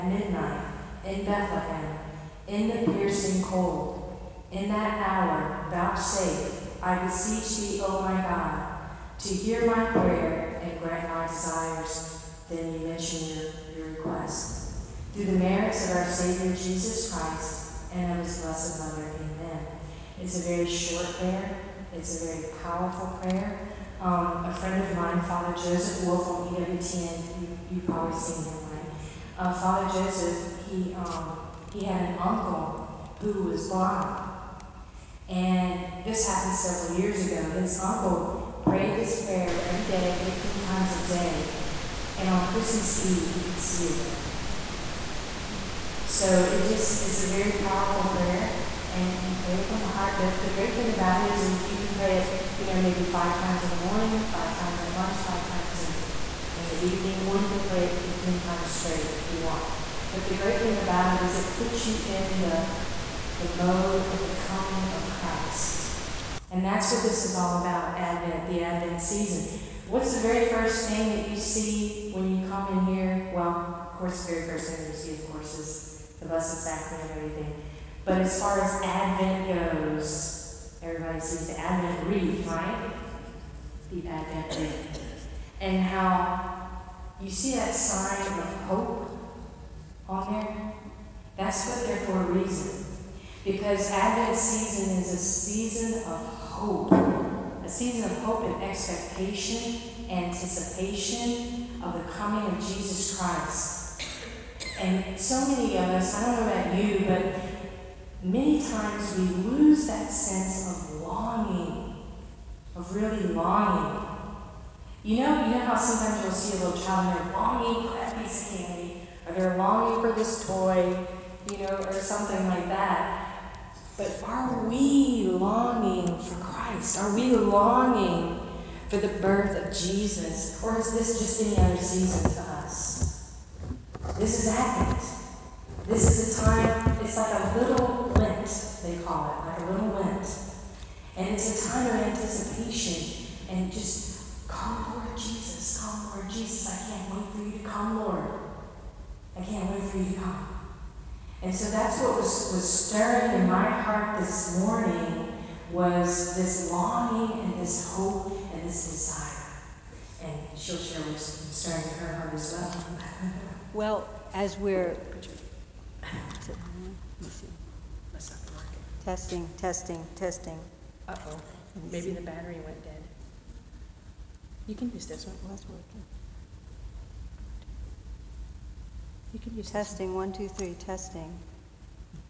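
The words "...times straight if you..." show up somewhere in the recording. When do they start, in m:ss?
0:58.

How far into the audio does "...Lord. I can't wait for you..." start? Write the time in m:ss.
2:28.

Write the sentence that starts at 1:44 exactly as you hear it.
And so many of us, I don't know about you, but many times we lose that sense of longing, of really longing.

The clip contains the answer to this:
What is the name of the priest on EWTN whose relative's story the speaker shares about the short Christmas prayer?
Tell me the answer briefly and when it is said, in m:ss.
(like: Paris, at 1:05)
Father Joseph Wolfe, at 0:25.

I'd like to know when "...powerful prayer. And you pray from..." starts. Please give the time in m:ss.
0:47.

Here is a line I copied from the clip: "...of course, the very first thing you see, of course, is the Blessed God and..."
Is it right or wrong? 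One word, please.
wrong.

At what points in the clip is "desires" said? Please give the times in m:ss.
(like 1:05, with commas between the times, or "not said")
0:11, 2:38.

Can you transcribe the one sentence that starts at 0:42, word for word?
And on Christmas Eve, he could see again.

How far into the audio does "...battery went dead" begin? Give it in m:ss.
2:52.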